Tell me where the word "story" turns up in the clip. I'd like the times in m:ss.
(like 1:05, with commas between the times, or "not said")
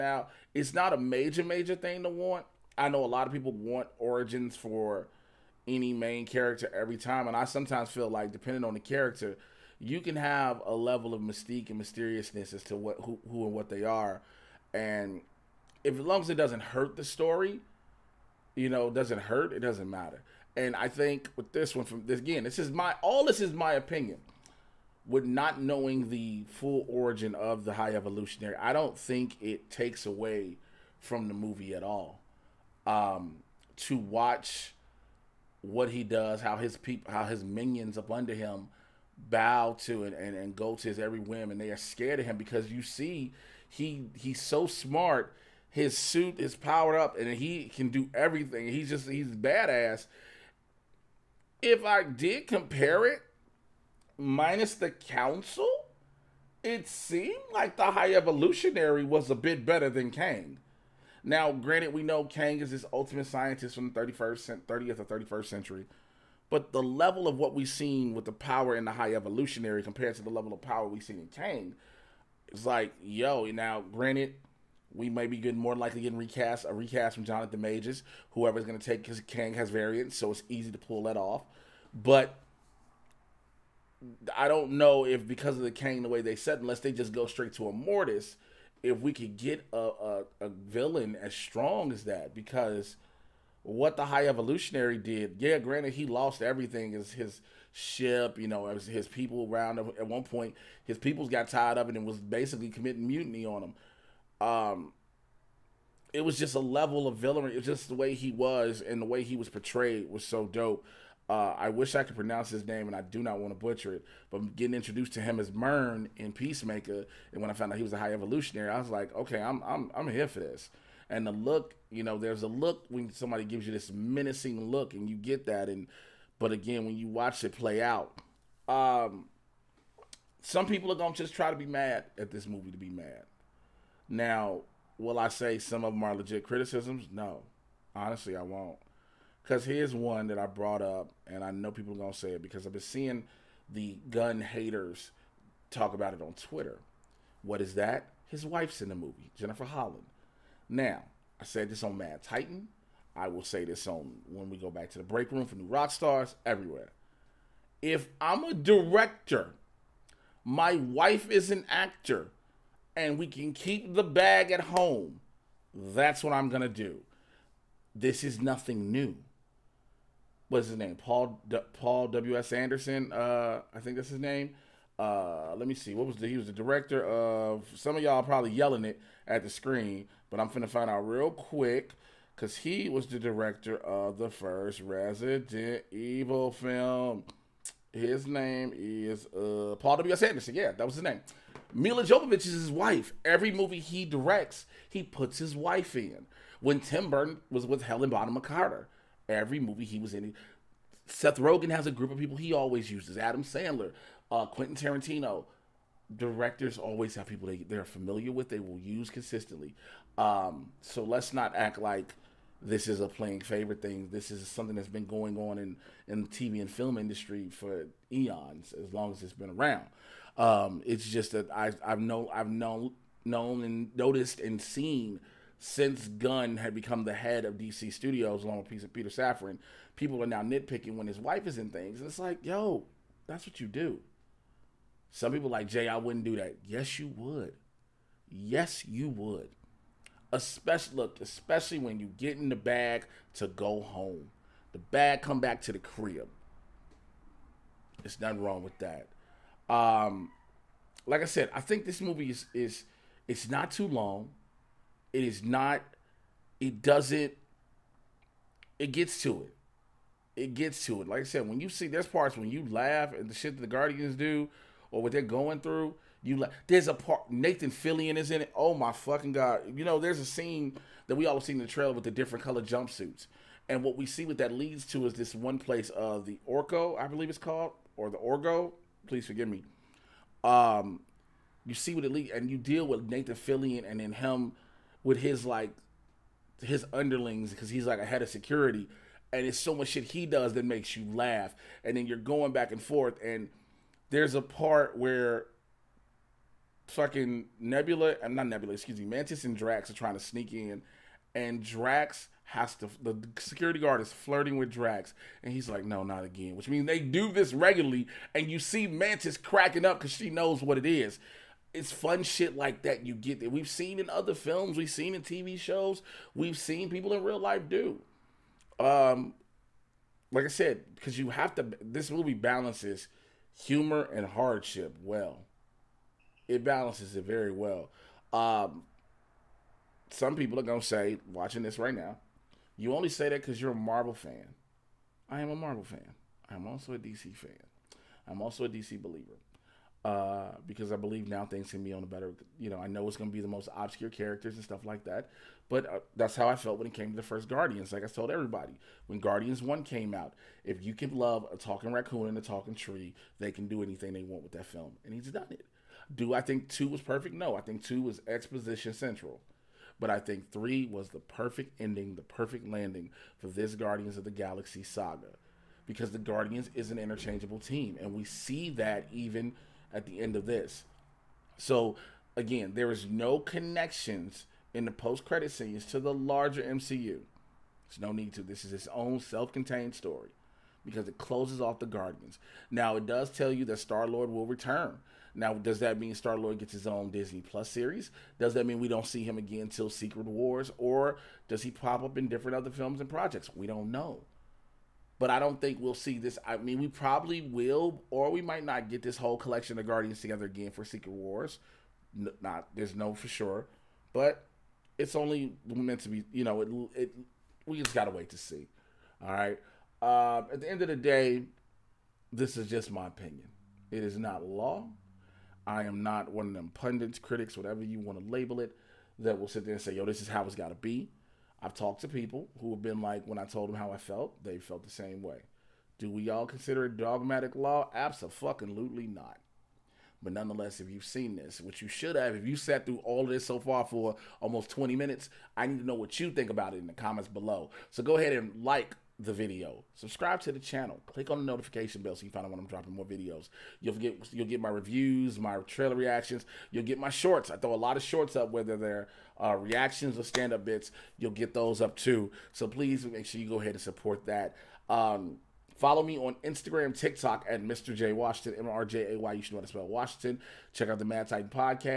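0:17, 6:19.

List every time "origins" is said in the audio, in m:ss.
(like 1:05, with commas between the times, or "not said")
0:03, 0:26.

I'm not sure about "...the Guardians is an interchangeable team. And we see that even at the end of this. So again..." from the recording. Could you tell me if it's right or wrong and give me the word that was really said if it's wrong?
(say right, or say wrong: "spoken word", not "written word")
right.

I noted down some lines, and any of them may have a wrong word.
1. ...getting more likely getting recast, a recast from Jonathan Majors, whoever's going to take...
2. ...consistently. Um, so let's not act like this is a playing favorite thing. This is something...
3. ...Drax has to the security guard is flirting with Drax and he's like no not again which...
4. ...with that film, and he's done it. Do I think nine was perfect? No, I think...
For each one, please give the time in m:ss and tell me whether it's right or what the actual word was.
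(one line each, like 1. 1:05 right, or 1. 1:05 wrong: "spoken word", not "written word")
1. 1:15 right
2. 3:29 right
3. 5:01 right
4. 5:54 wrong: "two", not "nine".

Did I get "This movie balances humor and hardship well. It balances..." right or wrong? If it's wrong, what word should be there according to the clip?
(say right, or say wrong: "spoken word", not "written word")
right.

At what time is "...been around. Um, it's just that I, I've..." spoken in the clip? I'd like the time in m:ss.
3:39.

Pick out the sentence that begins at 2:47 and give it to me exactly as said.
This is nothing new what's his name?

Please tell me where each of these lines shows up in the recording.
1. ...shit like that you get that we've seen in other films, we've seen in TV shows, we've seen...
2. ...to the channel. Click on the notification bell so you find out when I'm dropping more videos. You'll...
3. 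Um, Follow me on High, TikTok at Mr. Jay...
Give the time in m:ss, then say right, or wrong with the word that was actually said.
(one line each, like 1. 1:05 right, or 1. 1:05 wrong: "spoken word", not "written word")
1. 5:12 right
2. 7:20 right
3. 7:34 wrong: "Instagram", not "High".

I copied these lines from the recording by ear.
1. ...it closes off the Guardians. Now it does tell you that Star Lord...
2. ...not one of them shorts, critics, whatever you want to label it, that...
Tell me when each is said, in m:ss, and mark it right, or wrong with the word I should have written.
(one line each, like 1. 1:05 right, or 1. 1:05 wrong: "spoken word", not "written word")
1. 6:21 right
2. 6:56 wrong: "pundits", not "shorts".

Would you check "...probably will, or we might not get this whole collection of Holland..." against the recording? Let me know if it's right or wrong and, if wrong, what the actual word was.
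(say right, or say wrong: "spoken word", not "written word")
wrong: "Guardians", not "Holland".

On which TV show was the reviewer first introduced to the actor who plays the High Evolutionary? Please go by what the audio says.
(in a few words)
Peacemaker.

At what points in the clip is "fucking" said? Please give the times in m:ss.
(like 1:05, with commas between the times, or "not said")
4:28, 4:56.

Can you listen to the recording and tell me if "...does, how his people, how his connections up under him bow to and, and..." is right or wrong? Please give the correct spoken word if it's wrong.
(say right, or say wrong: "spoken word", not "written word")
wrong: "minions", not "connections".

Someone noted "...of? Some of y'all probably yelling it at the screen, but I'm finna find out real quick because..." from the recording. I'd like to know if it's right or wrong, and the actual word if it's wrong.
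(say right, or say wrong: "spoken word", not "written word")
right.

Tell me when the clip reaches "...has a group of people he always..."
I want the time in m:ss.
3:21.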